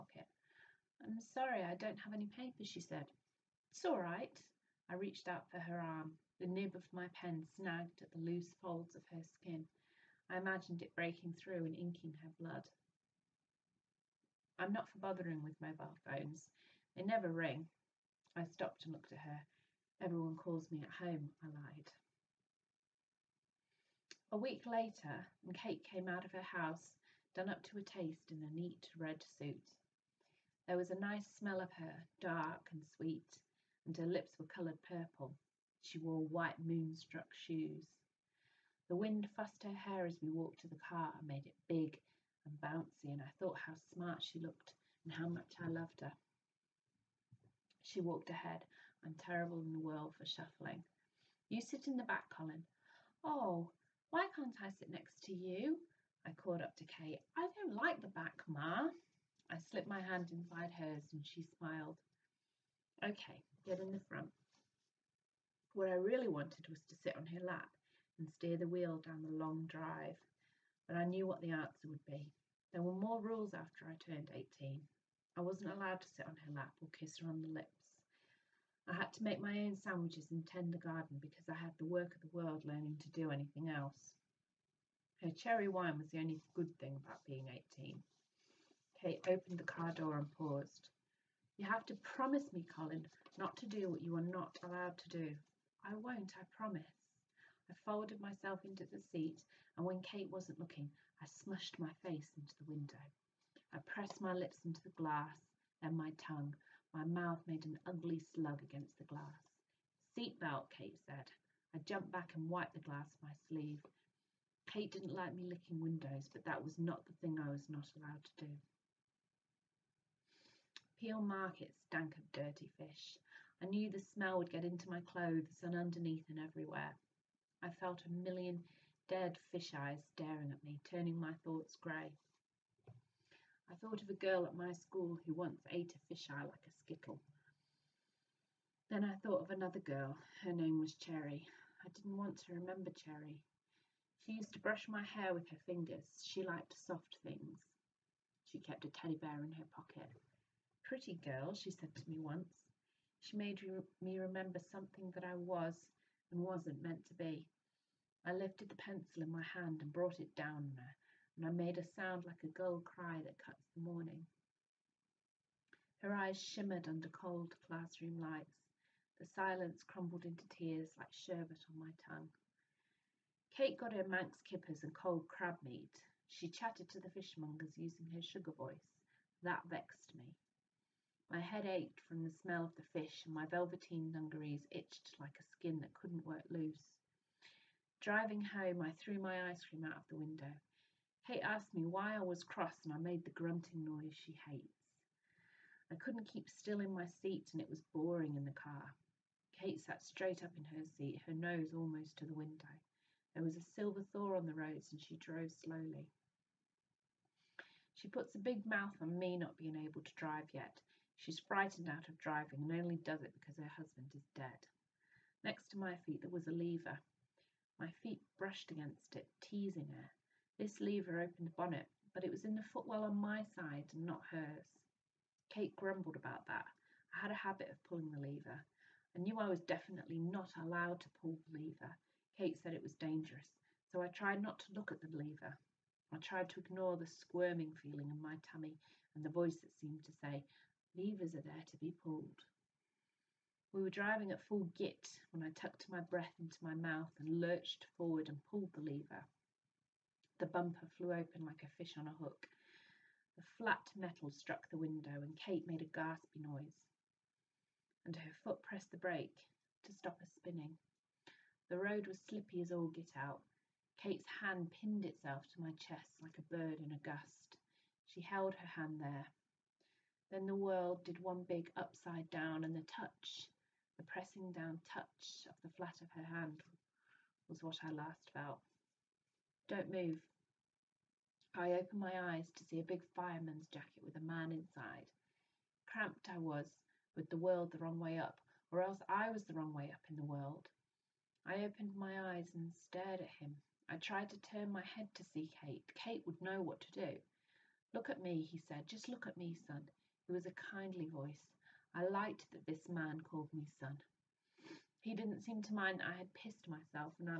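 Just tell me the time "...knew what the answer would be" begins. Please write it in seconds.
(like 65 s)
71 s.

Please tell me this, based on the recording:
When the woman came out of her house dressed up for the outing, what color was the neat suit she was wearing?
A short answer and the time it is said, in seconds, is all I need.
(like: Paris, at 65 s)
red, at 28 s.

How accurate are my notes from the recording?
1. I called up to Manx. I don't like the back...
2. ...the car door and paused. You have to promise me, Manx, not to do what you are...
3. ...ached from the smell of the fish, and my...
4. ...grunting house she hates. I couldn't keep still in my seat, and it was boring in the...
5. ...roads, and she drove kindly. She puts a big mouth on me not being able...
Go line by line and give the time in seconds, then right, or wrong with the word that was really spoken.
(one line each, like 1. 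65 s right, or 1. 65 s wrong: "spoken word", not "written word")
1. 56 s wrong: "Kate", not "Manx"
2. 89 s wrong: "Colin", not "Manx"
3. 181 s right
4. 193 s wrong: "noise", not "house"
5. 204 s wrong: "slowly", not "kindly".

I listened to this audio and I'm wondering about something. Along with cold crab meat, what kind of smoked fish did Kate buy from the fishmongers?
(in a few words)
Manx kippers.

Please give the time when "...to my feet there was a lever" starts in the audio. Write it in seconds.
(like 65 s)
215 s.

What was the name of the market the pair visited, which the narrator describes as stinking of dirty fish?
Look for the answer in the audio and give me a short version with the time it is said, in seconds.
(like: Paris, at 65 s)
Peel Market, at 120 s.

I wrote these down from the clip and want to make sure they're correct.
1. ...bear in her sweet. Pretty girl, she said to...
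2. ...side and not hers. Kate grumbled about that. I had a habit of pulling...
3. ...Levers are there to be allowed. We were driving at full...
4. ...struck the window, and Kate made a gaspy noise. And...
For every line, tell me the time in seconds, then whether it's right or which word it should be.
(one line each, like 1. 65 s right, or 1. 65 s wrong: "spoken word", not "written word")
1. 149 s wrong: "pocket", not "sweet"
2. 223 s right
3. 240 s wrong: "pulled", not "allowed"
4. 254 s right.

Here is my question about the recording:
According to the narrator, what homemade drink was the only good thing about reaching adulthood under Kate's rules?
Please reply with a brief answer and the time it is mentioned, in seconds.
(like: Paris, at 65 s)
cherry wine, at 85 s.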